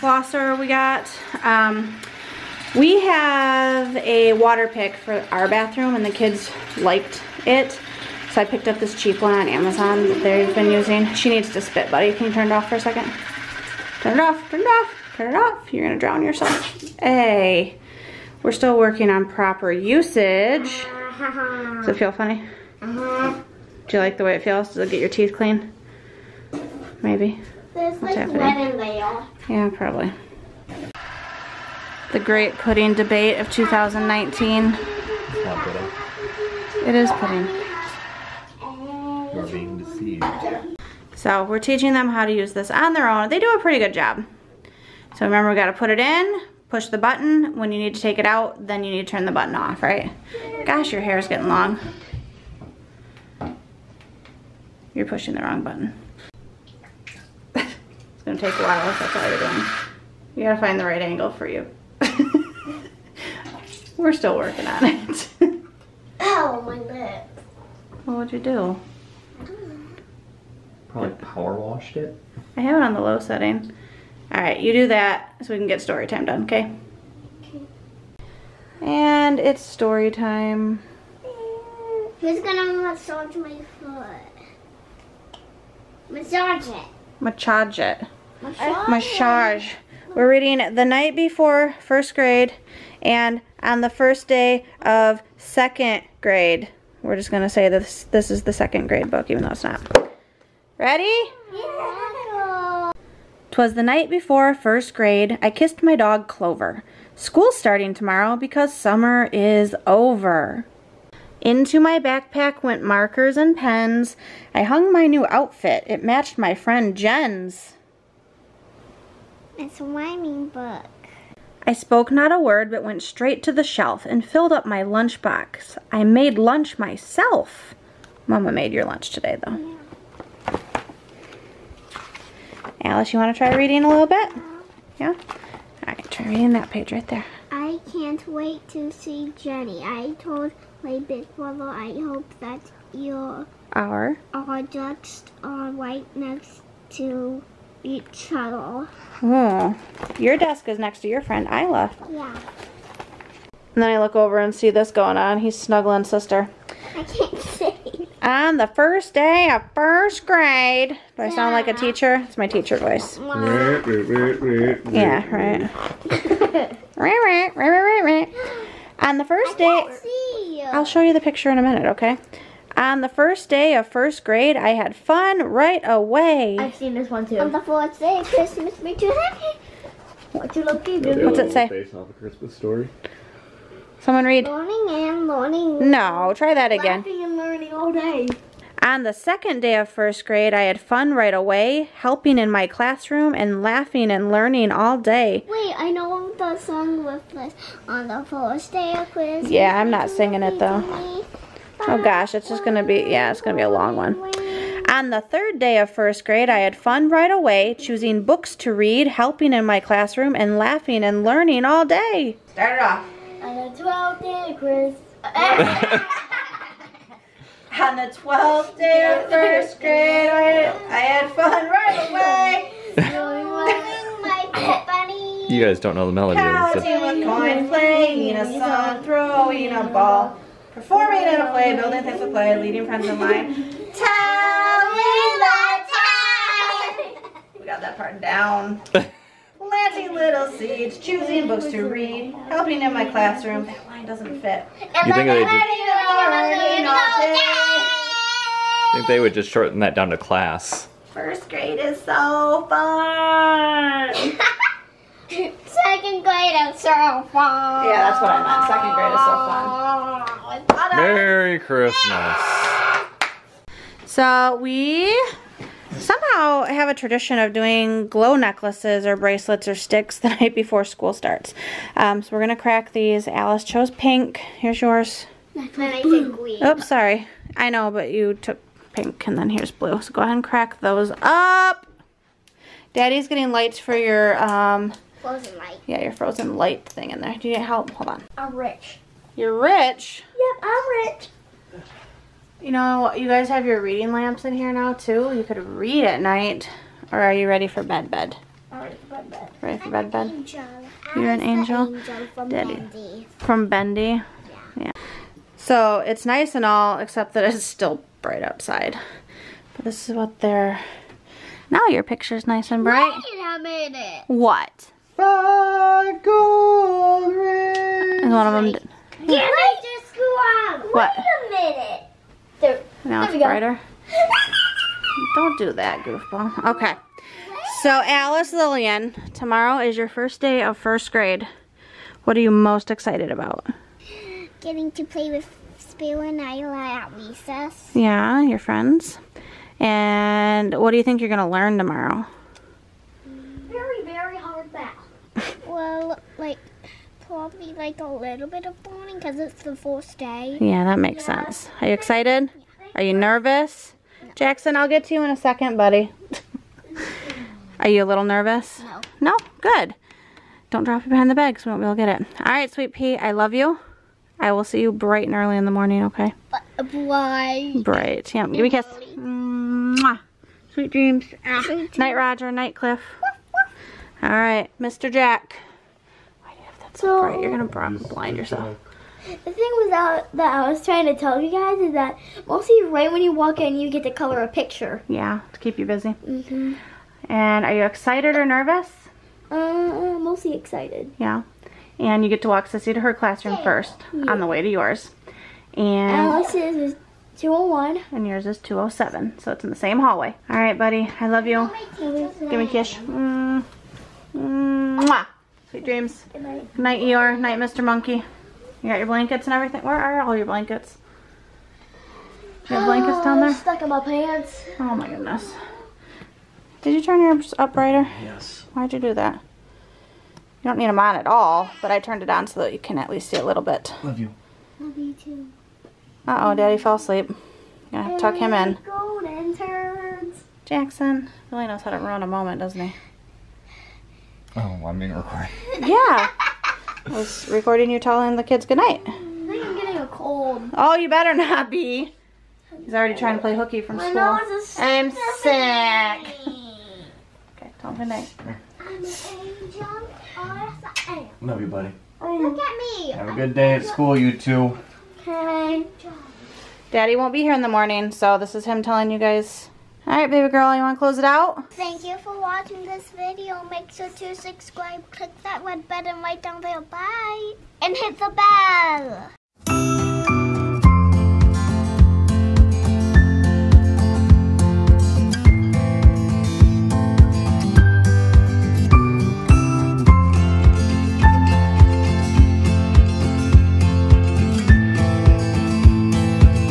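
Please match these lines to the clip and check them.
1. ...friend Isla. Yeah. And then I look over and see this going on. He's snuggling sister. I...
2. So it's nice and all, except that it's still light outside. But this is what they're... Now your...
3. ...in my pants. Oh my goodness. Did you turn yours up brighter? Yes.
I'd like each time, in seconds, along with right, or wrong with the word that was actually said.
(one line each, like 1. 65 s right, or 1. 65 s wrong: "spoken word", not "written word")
1. 151 s right
2. 305 s wrong: "bright", not "light"
3. 413 s right.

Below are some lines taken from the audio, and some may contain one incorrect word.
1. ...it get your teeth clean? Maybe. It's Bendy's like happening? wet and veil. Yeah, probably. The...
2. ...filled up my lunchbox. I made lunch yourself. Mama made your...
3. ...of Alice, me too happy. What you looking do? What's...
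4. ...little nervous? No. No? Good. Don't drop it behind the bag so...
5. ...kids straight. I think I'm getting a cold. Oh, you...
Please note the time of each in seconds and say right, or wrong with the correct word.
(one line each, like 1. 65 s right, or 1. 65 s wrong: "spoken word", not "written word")
1. 24 s wrong: "What", not "Bendy"
2. 124 s wrong: "myself", not "yourself"
3. 178 s wrong: "Christmas", not "Alice"
4. 358 s right
5. 438 s wrong: "goodnight", not "straight".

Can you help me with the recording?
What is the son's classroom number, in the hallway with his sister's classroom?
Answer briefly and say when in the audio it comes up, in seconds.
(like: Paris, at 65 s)
207, at 398 s.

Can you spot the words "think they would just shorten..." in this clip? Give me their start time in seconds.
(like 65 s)
248 s.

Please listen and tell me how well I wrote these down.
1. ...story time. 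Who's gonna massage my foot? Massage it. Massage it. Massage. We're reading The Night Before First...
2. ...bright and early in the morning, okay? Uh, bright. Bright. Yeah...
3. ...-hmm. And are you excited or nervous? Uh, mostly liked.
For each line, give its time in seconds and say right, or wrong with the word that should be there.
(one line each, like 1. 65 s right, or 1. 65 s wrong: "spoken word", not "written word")
1. 79 s right
2. 364 s right
3. 386 s wrong: "excited", not "liked".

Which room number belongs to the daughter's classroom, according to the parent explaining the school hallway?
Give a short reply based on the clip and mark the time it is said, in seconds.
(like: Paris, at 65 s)
201, at 396 s.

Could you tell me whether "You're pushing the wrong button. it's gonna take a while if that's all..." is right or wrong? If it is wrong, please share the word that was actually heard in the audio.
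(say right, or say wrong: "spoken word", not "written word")
right.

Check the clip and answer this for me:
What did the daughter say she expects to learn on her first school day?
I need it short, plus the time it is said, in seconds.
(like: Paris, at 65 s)
Very hard math, at 343 s.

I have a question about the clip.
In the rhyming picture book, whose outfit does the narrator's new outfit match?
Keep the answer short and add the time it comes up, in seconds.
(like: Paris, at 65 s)
Jen, at 115 s.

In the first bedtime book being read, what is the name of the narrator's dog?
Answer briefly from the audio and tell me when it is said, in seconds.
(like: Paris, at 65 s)
Clover, at 105 s.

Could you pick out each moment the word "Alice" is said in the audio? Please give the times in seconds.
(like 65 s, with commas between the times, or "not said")
132 s, 273 s, 328 s, 396 s.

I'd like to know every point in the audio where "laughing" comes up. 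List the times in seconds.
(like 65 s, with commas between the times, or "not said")
186 s, 193 s, 210 s.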